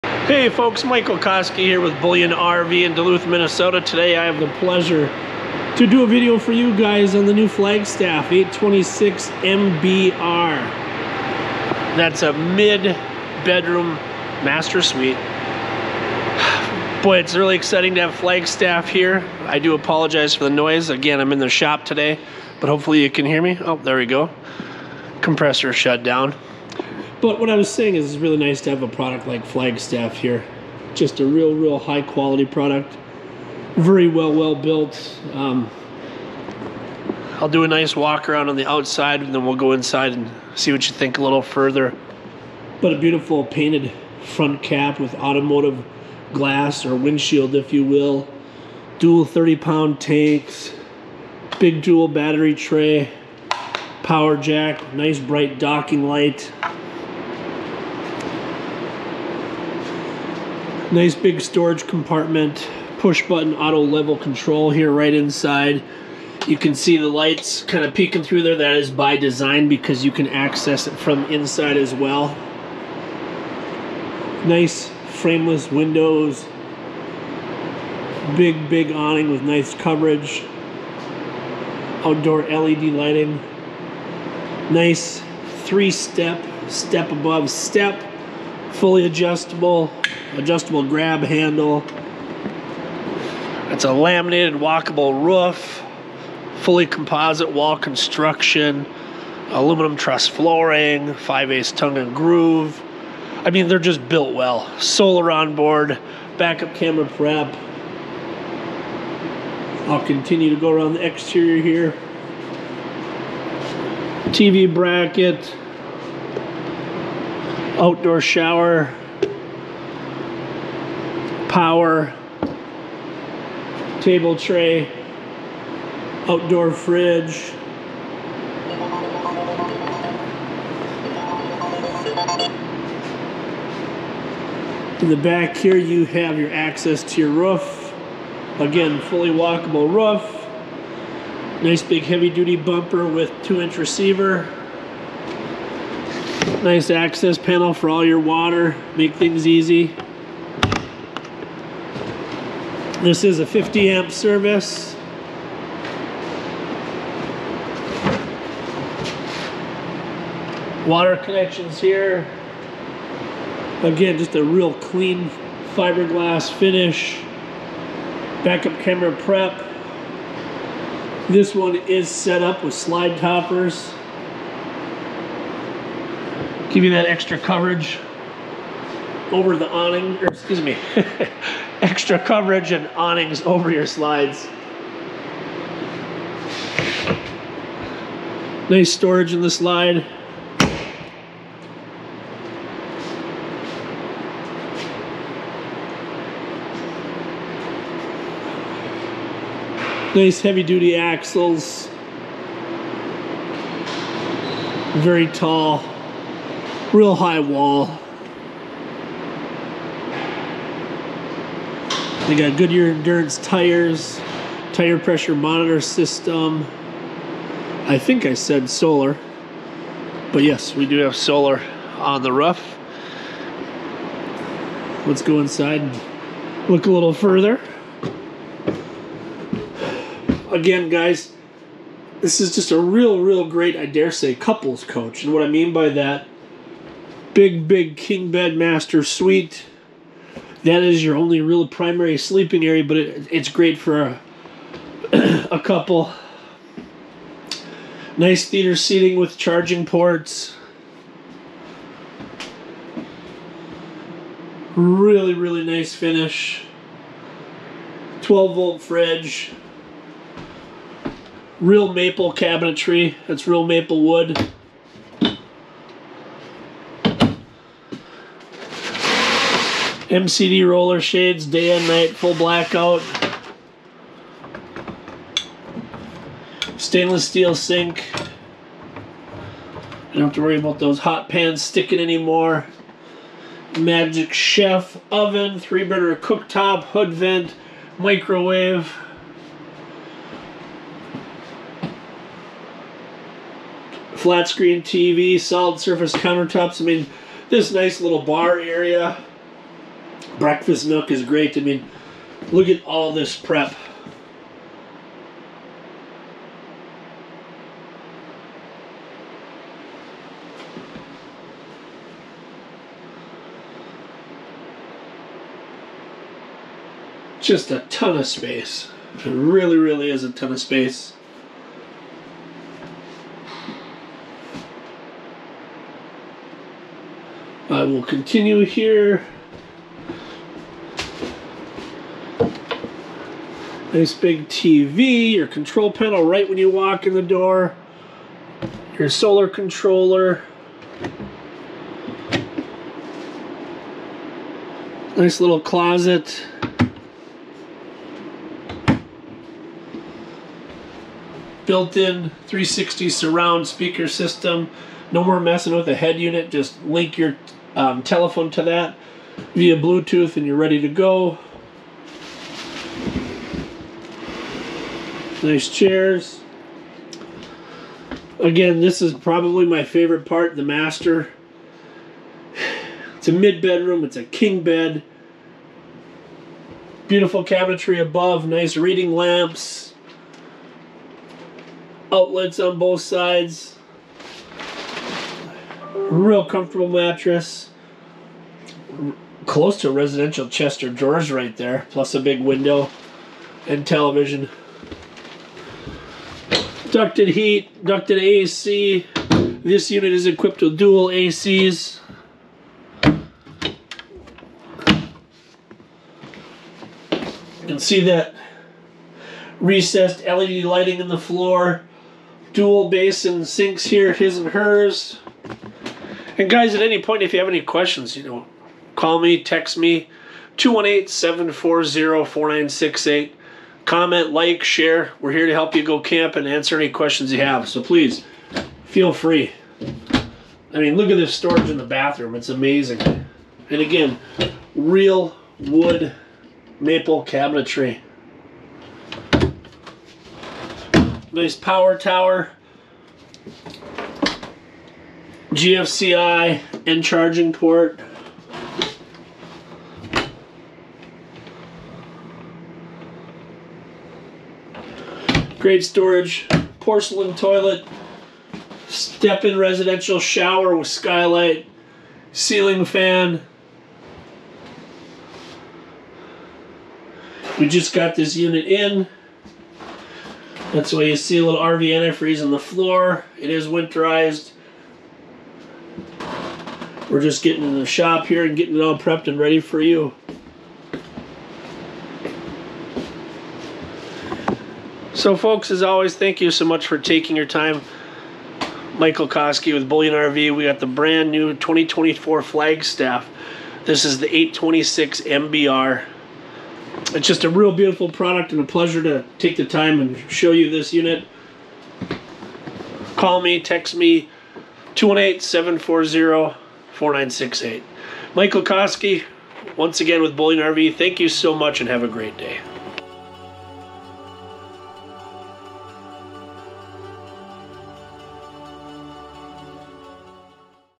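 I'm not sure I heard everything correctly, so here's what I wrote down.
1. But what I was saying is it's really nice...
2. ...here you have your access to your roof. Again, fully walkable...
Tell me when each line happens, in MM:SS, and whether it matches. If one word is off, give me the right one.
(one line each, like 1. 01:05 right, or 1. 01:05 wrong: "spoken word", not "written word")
1. 00:27 right
2. 02:15 right.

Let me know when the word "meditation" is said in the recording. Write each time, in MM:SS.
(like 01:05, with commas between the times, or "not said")
not said.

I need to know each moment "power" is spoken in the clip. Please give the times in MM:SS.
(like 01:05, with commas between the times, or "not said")
00:54, 02:01, 07:21.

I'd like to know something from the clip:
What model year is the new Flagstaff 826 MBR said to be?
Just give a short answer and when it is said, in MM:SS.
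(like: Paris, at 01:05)
2024, at 08:11.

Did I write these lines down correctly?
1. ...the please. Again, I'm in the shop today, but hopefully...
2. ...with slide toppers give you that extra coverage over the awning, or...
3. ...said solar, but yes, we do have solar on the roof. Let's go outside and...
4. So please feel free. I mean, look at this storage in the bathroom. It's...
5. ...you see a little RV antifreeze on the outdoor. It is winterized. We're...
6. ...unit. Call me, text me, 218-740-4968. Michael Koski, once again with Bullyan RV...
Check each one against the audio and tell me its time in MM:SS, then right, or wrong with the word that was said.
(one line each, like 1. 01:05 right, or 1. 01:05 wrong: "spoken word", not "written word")
1. 00:20 wrong: "noise", not "please"
2. 02:52 right
3. 03:38 wrong: "inside", not "outside"
4. 07:07 right
5. 07:51 wrong: "floor", not "outdoor"
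6. 08:20 right.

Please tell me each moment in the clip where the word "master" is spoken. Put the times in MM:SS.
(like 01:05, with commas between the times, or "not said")
00:14, 03:58, 06:10.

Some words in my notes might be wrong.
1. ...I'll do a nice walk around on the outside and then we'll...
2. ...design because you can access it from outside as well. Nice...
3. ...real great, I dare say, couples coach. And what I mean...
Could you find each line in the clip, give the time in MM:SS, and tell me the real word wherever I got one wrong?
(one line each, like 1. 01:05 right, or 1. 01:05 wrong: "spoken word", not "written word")
1. 00:37 right
2. 01:09 wrong: "inside", not "outside"
3. 03:53 right.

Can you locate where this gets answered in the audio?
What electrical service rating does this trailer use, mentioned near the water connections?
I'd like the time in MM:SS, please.
02:33.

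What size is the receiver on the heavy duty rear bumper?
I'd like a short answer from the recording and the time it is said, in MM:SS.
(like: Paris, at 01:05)
two inch, at 02:23.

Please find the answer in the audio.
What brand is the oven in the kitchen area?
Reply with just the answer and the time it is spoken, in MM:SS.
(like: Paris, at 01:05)
Magic Chef, at 04:43.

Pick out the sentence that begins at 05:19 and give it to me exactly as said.
It really, really is a ton of space.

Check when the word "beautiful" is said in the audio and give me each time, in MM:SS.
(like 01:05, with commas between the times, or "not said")
00:42, 06:17, 08:17.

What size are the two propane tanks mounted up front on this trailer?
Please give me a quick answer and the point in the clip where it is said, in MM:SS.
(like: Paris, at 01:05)
30 pound, at 00:49.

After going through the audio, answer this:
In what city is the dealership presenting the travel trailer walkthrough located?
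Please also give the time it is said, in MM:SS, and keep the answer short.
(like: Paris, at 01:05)
Duluth, at 00:02.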